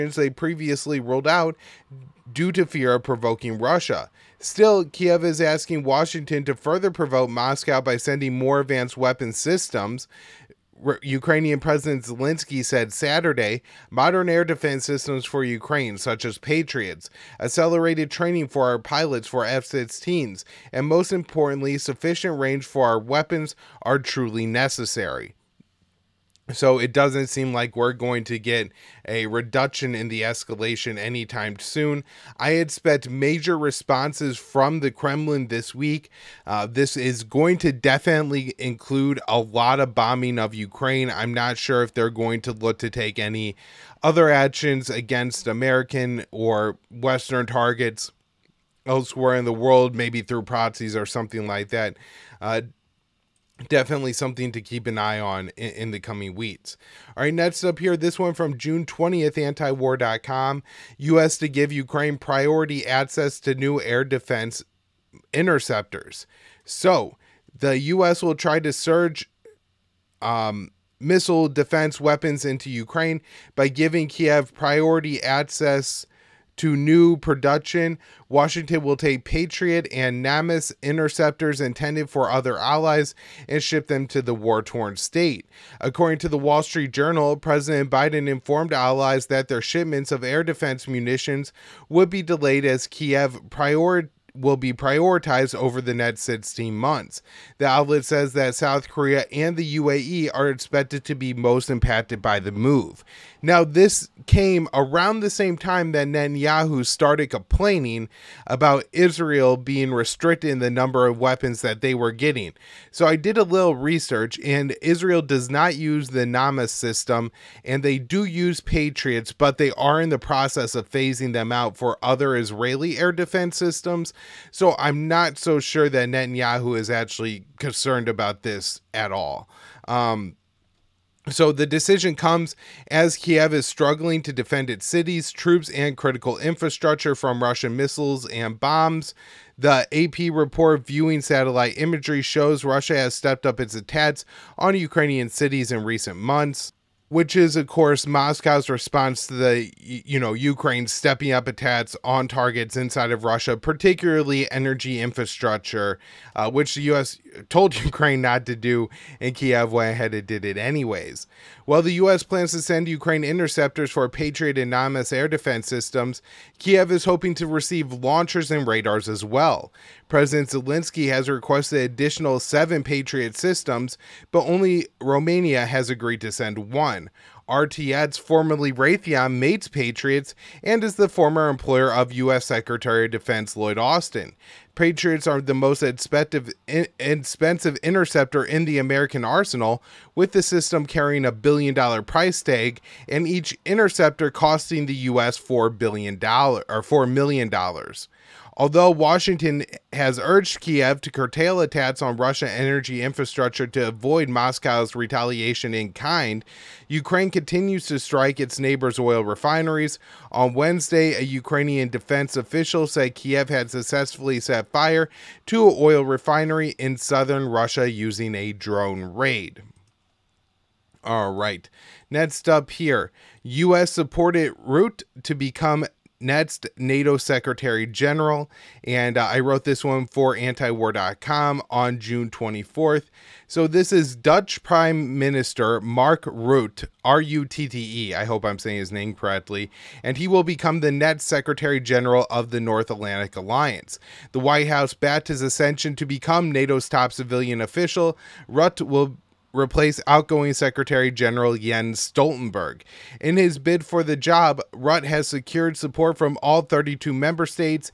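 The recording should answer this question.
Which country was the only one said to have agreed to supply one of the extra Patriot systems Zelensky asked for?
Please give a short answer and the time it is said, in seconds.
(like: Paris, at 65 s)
Romania, at 174 s.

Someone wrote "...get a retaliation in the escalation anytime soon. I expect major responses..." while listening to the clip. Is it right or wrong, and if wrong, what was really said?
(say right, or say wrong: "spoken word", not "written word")
wrong: "reduction", not "retaliation".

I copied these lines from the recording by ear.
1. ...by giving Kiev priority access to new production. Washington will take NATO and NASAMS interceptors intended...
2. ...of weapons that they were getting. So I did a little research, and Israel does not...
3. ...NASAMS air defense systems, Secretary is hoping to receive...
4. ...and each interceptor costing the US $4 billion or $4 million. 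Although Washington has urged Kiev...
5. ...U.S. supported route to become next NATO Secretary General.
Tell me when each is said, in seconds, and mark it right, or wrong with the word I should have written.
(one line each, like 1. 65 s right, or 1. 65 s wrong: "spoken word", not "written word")
1. 73 s wrong: "Patriot", not "NATO"
2. 111 s right
3. 164 s wrong: "Kiev", not "Secretary"
4. 193 s right
5. 223 s right.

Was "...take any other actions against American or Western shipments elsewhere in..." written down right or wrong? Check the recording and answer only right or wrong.
wrong.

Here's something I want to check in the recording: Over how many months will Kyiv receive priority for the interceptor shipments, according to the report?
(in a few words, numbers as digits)
16 months.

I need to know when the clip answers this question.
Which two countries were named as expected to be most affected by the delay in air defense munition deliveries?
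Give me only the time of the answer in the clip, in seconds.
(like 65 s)
98 s.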